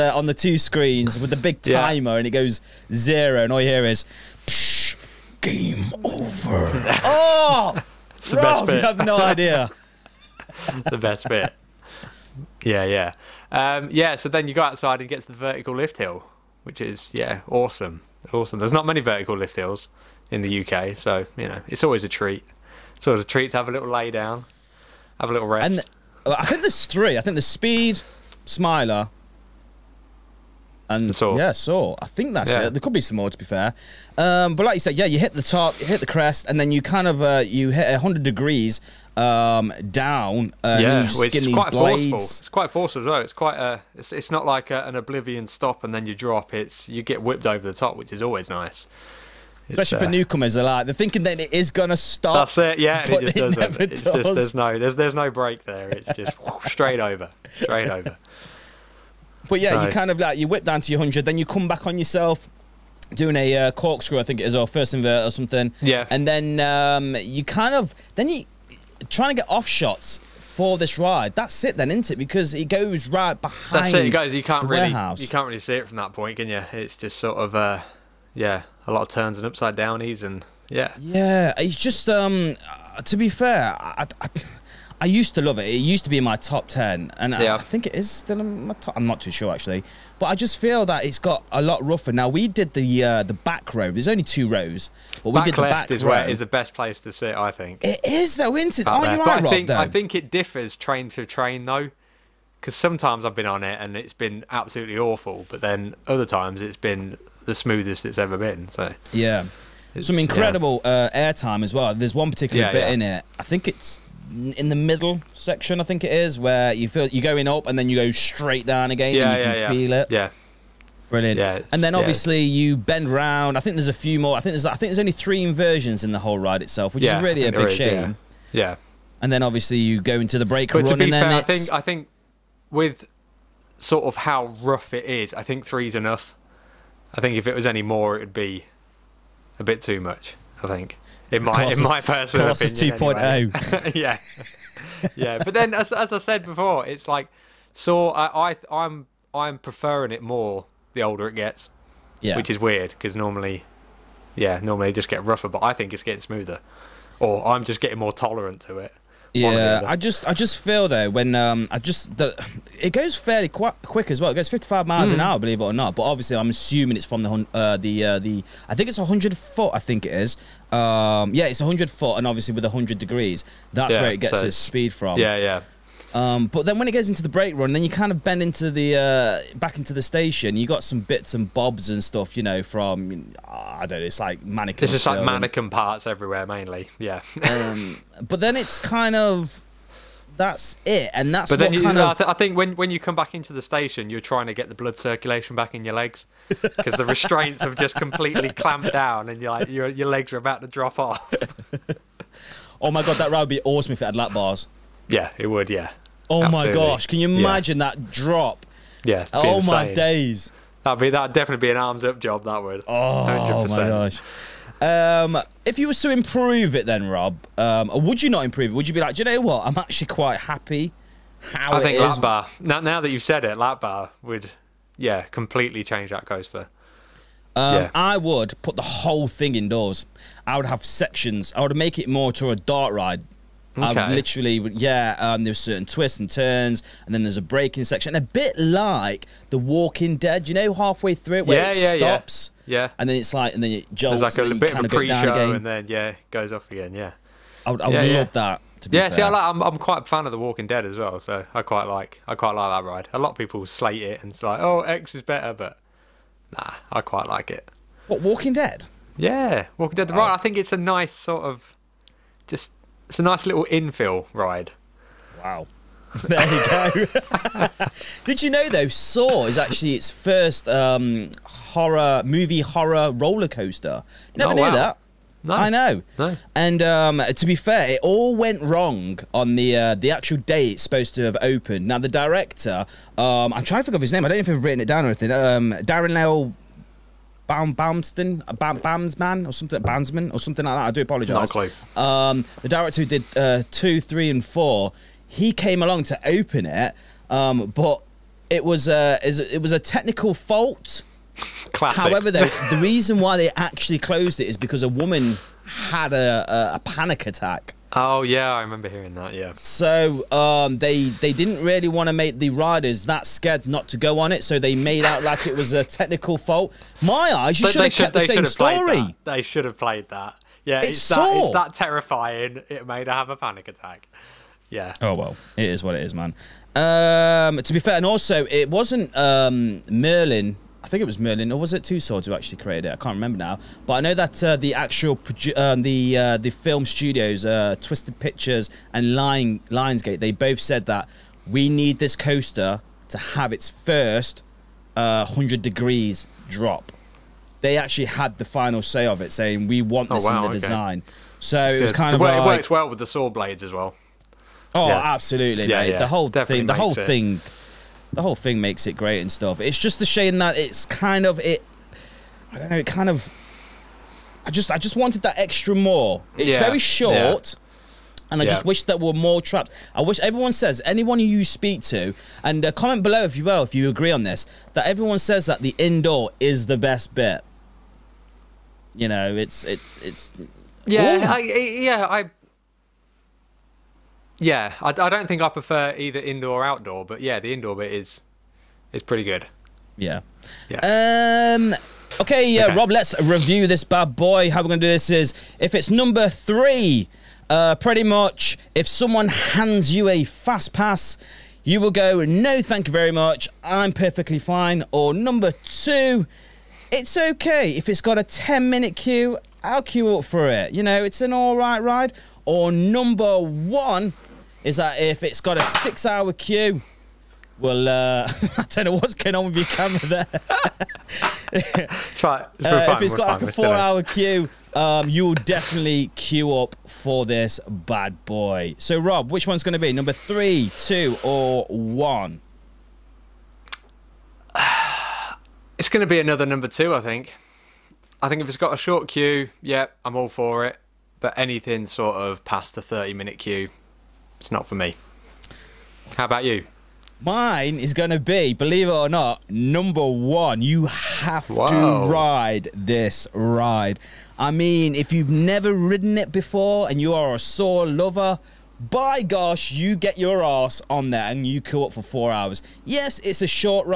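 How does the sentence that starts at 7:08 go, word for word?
So, Rob, which one's going to be number three, two, or one?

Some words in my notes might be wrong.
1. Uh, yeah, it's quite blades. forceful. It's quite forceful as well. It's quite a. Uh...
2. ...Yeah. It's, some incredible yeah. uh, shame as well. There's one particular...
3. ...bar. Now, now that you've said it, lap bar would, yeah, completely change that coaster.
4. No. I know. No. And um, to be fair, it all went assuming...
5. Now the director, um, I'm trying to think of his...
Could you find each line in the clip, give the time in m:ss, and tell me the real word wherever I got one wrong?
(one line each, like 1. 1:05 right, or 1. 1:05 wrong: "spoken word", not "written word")
1. 0:40 right
2. 1:49 wrong: "airtime", not "shame"
3. 3:42 right
4. 4:35 wrong: "wrong", not "assuming"
5. 4:41 right.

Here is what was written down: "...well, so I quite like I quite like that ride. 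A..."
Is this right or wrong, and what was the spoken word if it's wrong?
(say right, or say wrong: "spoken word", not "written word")
right.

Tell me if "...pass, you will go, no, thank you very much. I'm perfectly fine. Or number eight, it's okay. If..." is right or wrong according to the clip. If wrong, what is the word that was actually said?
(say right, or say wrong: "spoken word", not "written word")
wrong: "two", not "eight".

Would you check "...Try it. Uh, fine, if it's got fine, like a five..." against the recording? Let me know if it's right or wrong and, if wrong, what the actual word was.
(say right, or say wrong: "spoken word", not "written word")
wrong: "four", not "five".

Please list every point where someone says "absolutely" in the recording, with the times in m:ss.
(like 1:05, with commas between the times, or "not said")
1:44, 3:26, 5:55.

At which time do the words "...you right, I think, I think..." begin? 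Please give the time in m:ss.
1:39.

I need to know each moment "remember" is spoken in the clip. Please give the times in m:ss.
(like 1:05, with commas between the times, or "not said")
5:08, 5:33.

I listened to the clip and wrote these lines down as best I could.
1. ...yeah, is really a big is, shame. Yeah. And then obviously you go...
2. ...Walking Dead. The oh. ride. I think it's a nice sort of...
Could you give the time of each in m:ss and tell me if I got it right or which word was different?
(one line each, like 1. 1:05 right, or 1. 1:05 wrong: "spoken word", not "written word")
1. 2:07 right
2. 4:19 right.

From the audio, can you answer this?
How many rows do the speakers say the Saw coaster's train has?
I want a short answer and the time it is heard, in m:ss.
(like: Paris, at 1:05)
2, at 1:34.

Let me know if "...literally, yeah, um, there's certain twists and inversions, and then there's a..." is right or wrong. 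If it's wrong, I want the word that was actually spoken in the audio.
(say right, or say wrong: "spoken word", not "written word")
wrong: "turns", not "inversions".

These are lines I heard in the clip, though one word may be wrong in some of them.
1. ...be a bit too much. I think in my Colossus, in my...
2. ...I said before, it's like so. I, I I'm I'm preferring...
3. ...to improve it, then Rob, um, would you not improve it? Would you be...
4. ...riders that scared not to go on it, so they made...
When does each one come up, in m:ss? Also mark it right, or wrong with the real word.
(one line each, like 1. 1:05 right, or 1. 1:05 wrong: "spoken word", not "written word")
1. 2:18 right
2. 2:26 right
3. 3:36 right
4. 5:12 right.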